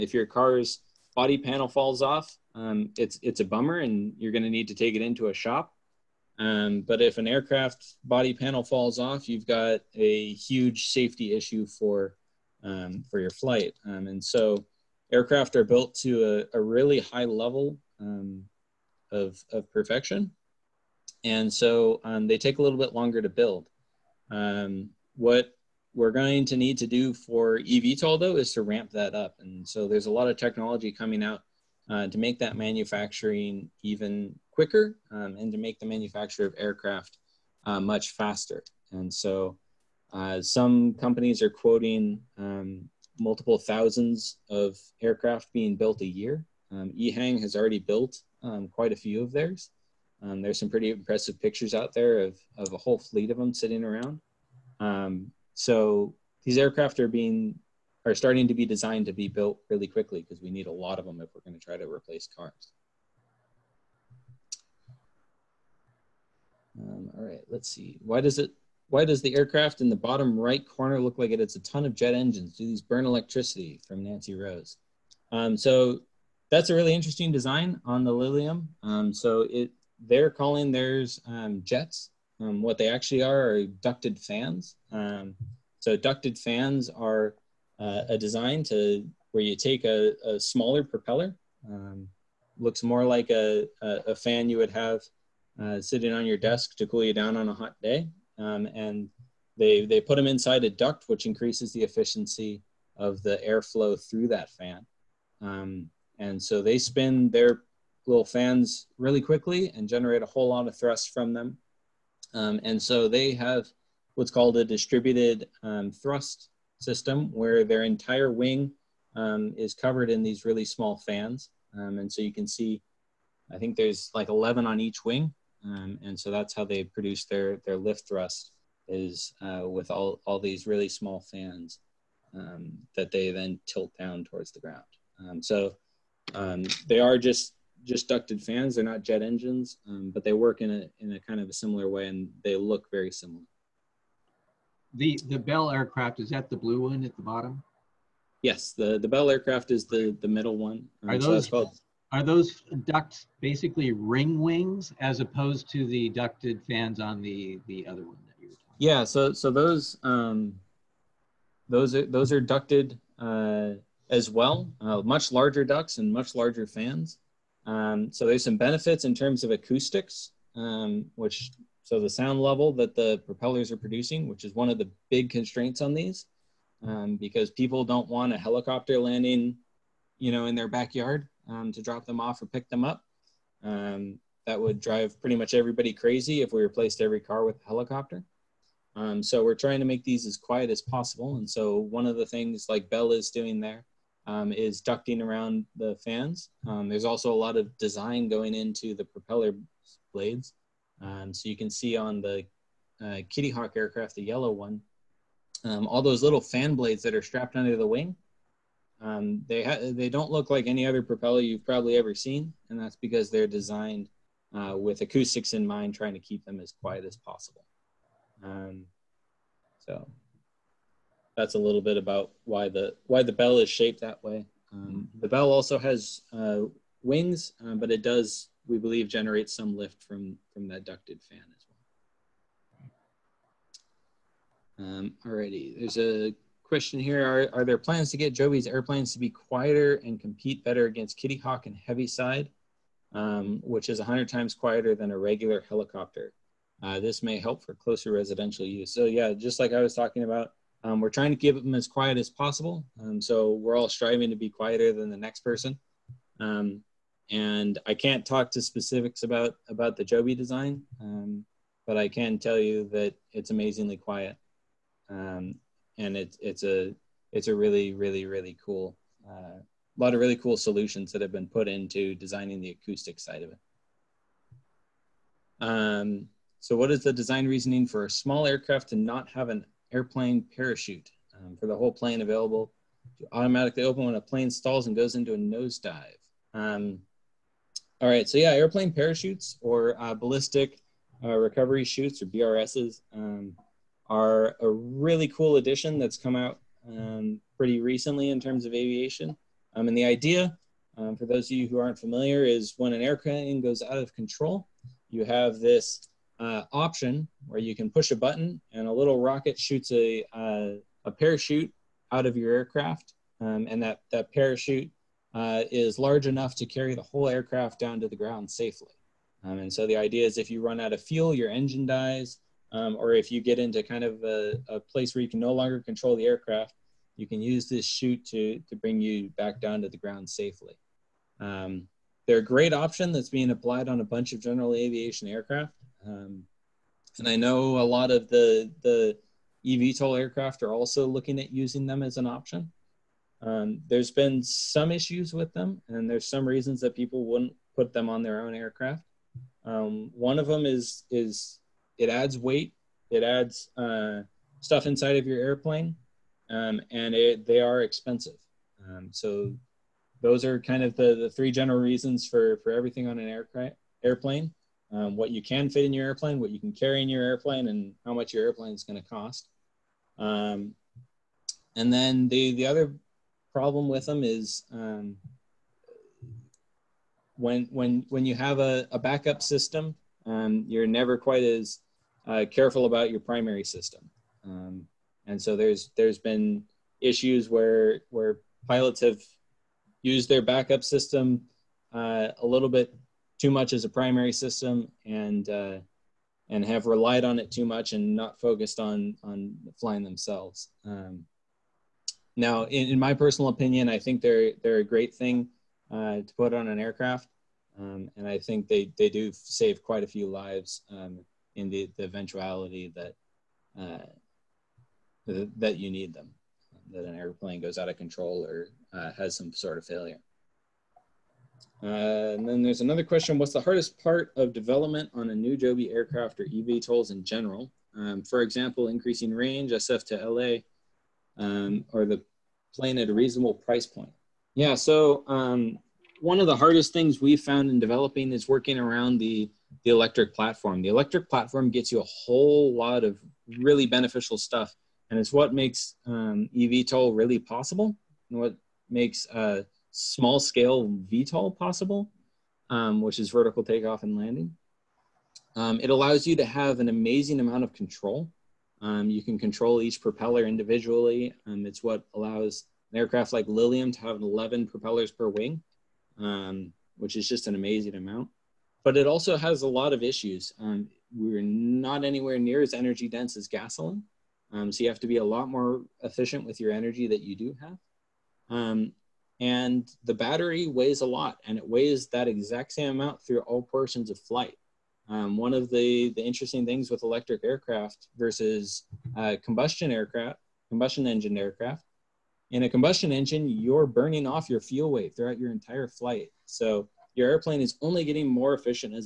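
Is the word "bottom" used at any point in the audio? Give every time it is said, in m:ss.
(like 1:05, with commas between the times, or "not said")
1:09, 2:27.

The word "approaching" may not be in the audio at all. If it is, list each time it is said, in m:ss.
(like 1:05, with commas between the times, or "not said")
not said.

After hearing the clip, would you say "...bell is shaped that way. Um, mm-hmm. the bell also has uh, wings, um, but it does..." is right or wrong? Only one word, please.
right.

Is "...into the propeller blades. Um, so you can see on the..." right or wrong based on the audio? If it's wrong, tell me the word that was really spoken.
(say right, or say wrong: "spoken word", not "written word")
right.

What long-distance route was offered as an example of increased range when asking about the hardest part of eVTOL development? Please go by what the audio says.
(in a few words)
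SF to LA.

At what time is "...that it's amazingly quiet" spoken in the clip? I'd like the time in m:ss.
4:22.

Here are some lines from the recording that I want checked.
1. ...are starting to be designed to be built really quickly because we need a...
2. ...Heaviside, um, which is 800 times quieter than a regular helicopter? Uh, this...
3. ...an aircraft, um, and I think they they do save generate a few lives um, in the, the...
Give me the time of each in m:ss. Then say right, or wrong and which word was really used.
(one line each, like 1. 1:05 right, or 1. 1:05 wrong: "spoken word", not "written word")
1. 0:58 right
2. 4:01 wrong: "100", not "800"
3. 6:46 wrong: "quite", not "generate".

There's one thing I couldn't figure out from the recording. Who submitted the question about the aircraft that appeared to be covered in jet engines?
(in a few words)
Nancy Rose.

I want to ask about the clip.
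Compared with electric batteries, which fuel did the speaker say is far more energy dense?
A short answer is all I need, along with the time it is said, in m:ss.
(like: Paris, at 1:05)
Gasoline, at 7:53.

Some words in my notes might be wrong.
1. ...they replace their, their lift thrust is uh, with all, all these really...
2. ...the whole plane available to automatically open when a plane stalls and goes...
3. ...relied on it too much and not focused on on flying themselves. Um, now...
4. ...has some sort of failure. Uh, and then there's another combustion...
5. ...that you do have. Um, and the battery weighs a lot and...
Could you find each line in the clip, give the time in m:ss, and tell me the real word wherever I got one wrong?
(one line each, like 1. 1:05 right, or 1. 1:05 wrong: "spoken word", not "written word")
1. 2:06 wrong: "produce", not "replace"
2. 4:41 right
3. 6:36 right
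4. 6:59 wrong: "question", not "combustion"
5. 7:57 right.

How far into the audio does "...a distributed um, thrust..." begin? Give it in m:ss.
1:54.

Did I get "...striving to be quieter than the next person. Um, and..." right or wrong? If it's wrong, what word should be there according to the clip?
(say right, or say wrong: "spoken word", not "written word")
right.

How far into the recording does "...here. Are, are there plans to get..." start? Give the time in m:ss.
3:56.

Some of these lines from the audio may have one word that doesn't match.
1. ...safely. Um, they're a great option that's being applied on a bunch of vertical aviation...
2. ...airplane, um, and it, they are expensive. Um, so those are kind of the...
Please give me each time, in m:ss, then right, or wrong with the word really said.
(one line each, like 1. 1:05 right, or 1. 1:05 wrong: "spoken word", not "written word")
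1. 5:30 wrong: "general", not "vertical"
2. 5:55 right.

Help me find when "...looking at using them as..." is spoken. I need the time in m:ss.
5:41.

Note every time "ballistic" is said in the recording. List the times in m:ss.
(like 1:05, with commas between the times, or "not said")
4:50.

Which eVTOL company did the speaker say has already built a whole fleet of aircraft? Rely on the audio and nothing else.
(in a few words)
EHang.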